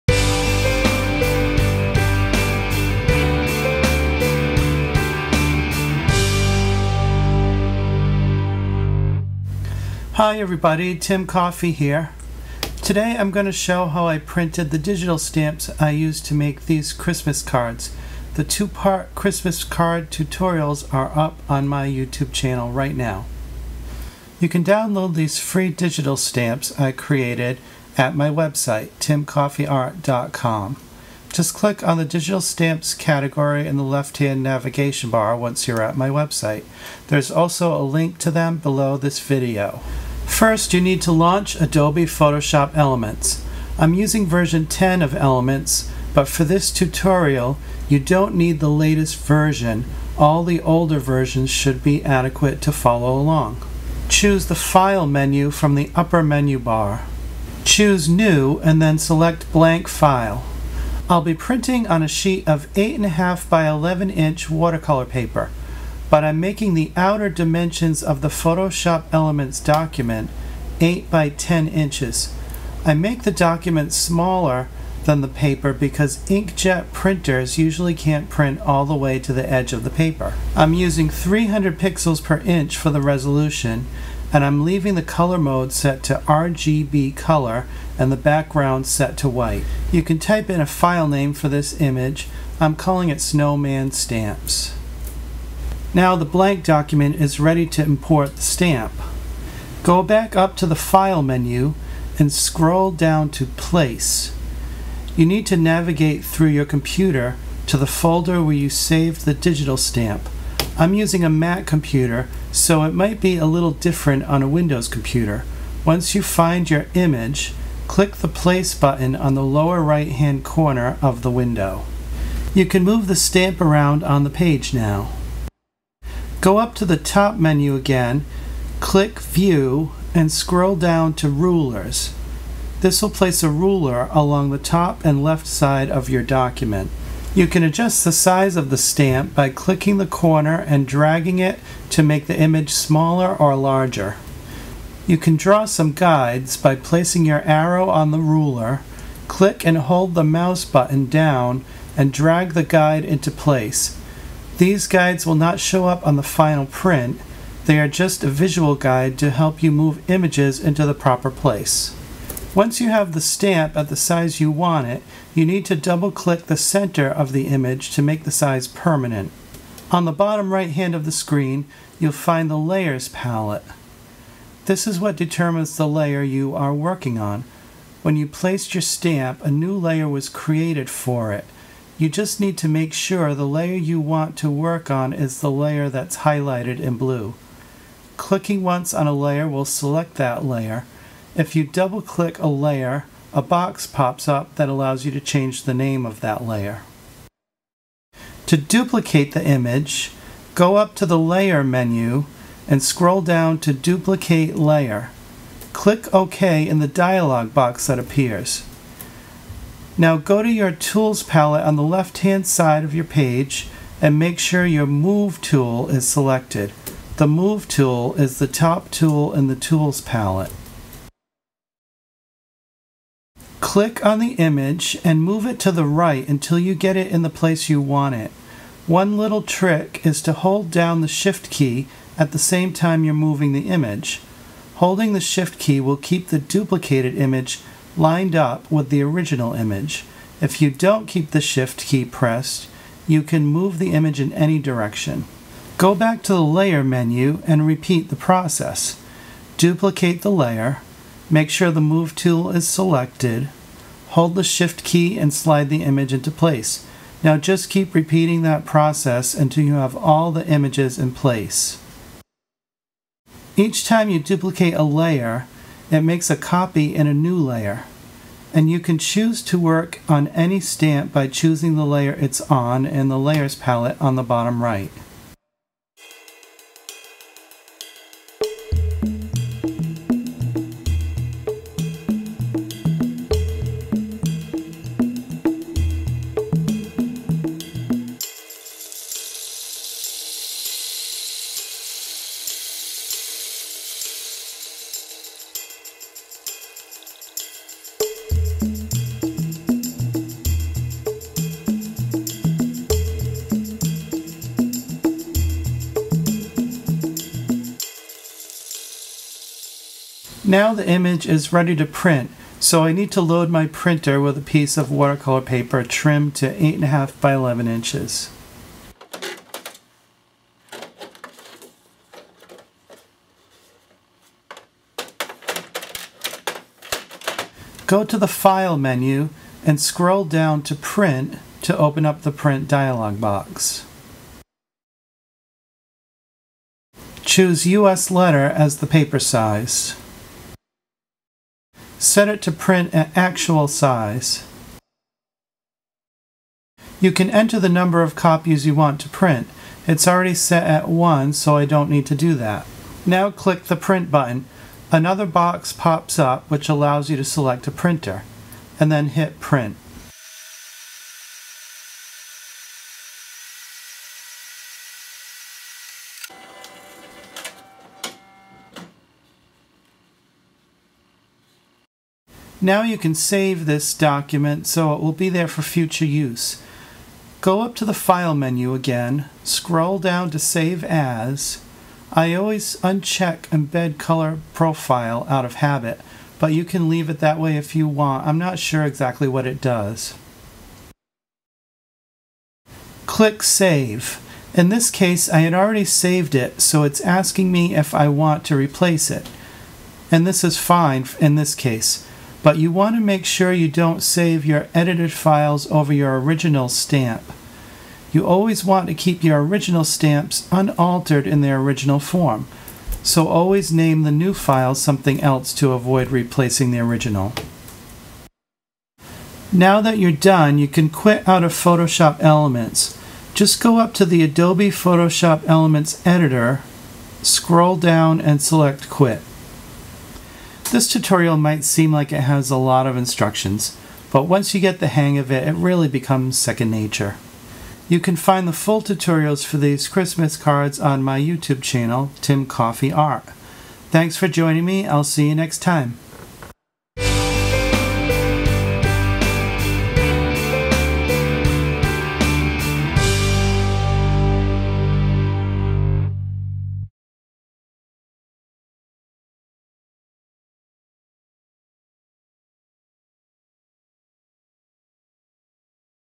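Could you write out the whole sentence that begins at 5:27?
Go to the File menu and scroll down to Print to open up the Print dialog box.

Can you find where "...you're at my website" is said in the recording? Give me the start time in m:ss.
0:35.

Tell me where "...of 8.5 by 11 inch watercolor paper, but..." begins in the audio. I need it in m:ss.
1:02.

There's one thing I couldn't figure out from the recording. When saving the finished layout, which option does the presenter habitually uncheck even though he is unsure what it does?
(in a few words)
Embed Color Profile.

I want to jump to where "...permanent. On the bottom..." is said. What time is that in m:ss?
2:48.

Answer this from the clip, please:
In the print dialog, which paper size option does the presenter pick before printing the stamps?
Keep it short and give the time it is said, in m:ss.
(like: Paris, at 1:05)
US letter, at 5:37.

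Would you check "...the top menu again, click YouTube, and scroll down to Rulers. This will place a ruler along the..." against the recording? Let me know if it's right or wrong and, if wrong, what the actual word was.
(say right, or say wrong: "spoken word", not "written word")
wrong: "View", not "YouTube".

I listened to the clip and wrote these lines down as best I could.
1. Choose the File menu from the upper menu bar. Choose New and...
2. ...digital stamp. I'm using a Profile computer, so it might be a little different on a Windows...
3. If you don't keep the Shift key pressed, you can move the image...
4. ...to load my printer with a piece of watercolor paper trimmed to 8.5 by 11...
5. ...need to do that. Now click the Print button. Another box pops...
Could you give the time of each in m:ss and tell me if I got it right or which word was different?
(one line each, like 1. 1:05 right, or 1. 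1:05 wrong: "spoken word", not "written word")
1. 0:54 right
2. 1:49 wrong: "Mac", not "Profile"
3. 4:00 right
4. 5:13 right
5. 5:51 right.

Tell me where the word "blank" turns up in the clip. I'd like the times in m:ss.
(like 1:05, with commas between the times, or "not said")
0:59, 1:36.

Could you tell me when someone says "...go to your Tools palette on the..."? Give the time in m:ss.
3:30.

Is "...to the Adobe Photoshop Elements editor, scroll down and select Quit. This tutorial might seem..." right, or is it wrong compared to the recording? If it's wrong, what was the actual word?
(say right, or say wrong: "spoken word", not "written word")
right.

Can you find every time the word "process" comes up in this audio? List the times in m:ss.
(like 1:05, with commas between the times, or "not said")
4:08, 4:18.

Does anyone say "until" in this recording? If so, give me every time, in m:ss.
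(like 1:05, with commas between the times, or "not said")
3:46, 4:19.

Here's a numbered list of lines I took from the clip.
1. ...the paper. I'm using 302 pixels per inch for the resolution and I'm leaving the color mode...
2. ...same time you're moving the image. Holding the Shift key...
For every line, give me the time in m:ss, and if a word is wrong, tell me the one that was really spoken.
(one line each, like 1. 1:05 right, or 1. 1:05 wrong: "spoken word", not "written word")
1. 1:19 wrong: "300", not "302"
2. 3:52 right.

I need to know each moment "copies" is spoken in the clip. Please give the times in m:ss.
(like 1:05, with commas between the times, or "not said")
5:48.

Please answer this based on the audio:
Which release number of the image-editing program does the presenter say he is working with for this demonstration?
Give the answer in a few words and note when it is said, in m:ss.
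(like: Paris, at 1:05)
10, at 0:44.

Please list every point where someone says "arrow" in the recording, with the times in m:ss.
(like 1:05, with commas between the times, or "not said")
2:27.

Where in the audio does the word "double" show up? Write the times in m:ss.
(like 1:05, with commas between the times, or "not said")
2:45, 3:11.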